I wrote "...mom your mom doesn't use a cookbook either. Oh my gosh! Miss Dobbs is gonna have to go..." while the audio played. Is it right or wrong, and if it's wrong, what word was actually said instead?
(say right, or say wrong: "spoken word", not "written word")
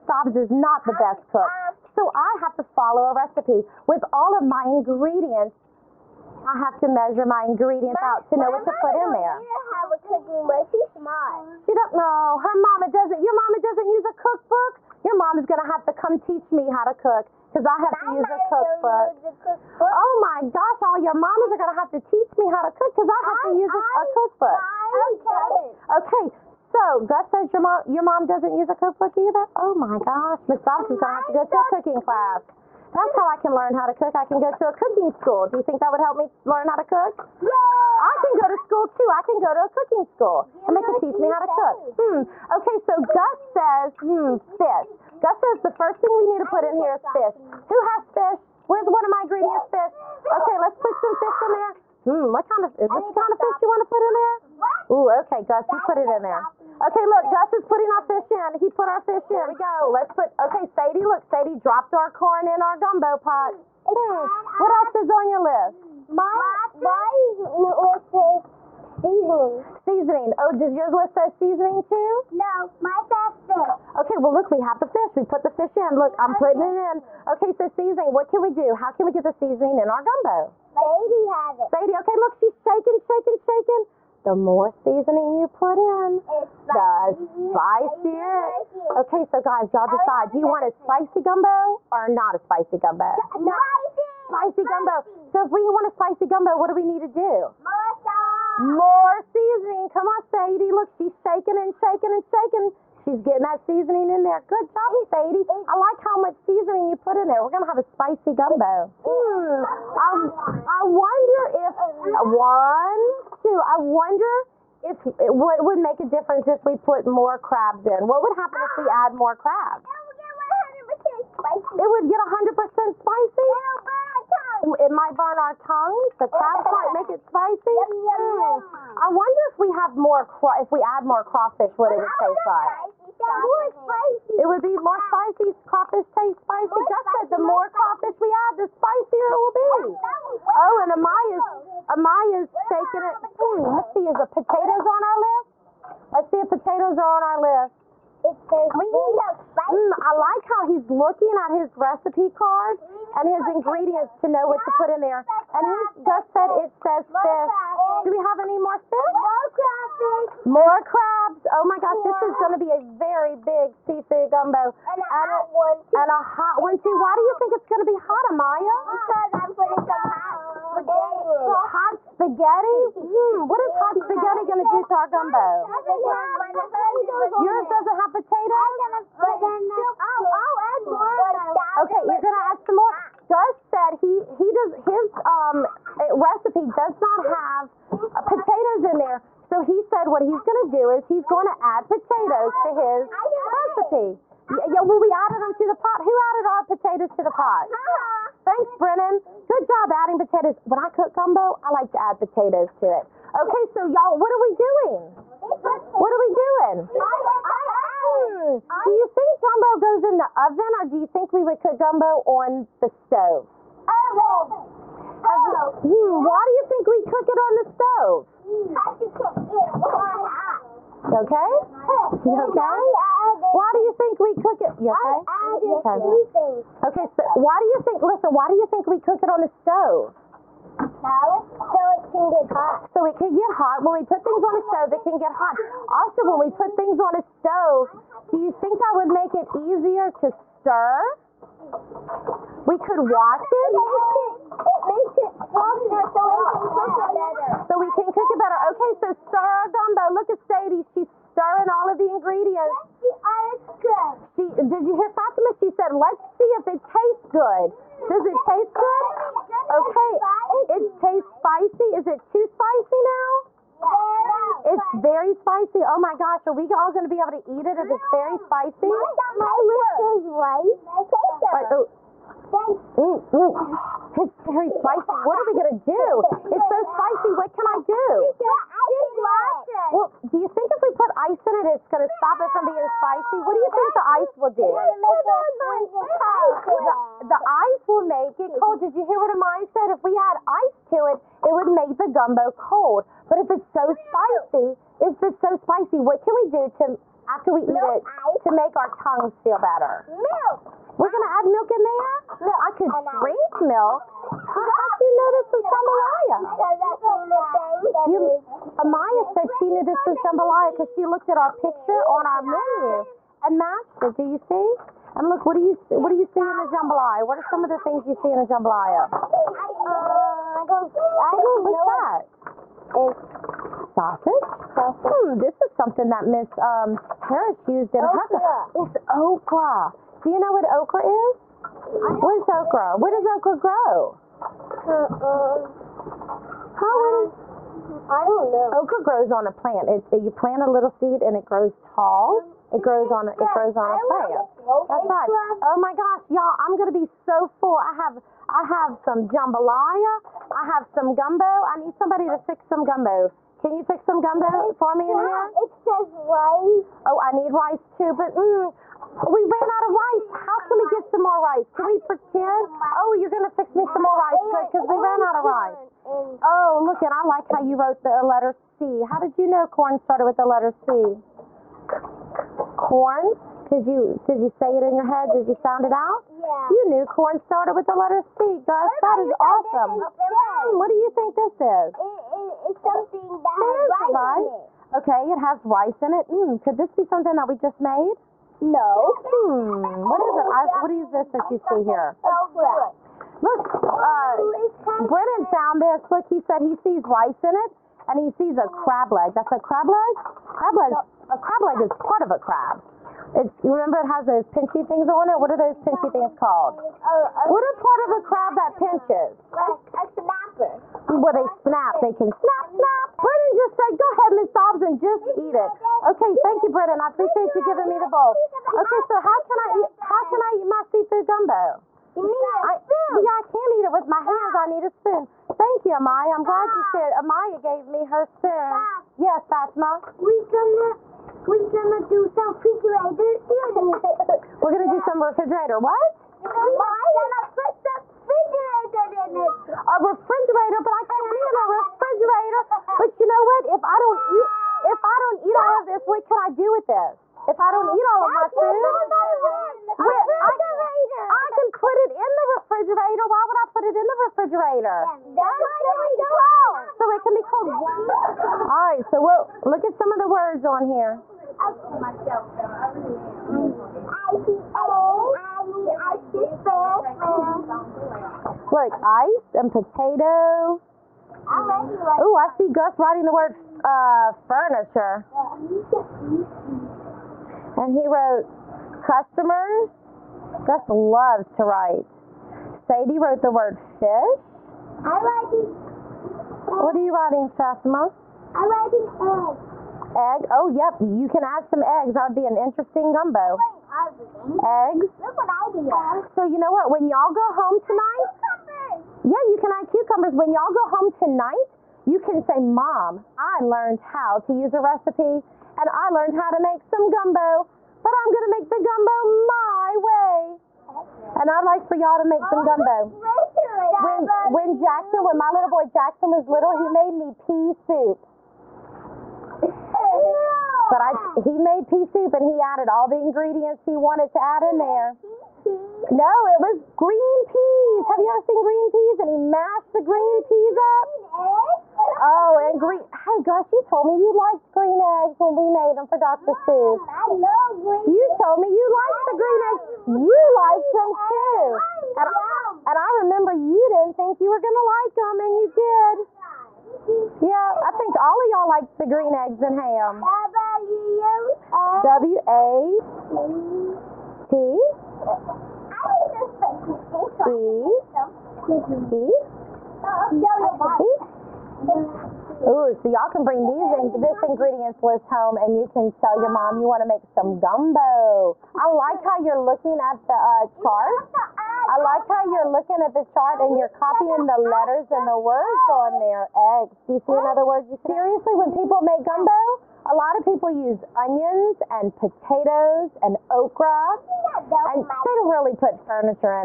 right.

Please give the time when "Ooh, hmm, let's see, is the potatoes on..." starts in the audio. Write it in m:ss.
2:23.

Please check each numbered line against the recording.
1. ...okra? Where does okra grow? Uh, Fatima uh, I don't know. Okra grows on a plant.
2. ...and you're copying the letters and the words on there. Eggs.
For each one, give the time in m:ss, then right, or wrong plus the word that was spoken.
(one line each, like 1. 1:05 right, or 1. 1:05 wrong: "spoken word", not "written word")
1. 5:32 wrong: "How", not "Fatima"
2. 9:33 right.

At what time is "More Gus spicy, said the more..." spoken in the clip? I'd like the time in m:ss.
2:16.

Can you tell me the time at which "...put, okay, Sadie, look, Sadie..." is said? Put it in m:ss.
1:00.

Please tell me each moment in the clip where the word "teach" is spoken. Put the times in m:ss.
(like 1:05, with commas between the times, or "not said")
0:16, 0:21, 0:40.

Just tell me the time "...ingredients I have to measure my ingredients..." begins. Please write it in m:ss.
0:04.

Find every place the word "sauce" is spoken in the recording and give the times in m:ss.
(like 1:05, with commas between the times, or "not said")
1:37.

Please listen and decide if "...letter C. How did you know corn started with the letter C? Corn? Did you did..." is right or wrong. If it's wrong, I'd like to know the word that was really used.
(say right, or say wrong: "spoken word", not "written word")
right.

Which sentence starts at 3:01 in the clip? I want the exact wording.
Okay, you're gonna add some more.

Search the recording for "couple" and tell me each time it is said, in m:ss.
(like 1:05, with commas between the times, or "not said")
not said.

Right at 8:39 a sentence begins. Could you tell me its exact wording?
But I, he made pea soup and he added all the ingredients he wanted to add in there.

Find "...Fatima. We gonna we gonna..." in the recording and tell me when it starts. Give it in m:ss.
7:09.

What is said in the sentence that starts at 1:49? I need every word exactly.
I, I wonder if, one, two, I wonder if, what would make a difference if we put more crabs in?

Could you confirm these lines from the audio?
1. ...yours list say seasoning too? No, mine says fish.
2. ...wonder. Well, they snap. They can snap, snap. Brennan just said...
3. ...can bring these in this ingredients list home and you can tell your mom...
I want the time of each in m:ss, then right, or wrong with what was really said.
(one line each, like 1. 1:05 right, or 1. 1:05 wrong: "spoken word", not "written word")
1. 1:10 right
2. 6:50 wrong: "snapper", not "wonder"
3. 9:23 right.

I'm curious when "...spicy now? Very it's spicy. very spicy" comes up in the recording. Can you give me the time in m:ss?
4:22.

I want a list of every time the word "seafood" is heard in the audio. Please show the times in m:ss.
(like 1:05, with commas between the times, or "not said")
2:43, 7:00.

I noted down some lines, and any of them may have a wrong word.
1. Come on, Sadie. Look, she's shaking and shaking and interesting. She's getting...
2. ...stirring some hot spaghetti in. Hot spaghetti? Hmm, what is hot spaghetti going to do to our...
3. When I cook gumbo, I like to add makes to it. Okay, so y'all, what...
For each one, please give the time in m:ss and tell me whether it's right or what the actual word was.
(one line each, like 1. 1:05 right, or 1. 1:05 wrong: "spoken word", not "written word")
1. 1:39 wrong: "shaking", not "interesting"
2. 2:49 wrong: "putting", not "stirring"
3. 3:20 wrong: "potatoes", not "makes".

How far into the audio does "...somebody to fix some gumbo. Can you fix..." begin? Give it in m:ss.
5:51.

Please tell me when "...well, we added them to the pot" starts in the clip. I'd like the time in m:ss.
3:14.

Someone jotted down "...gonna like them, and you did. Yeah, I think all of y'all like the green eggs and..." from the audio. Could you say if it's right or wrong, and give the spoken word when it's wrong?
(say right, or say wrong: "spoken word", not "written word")
right.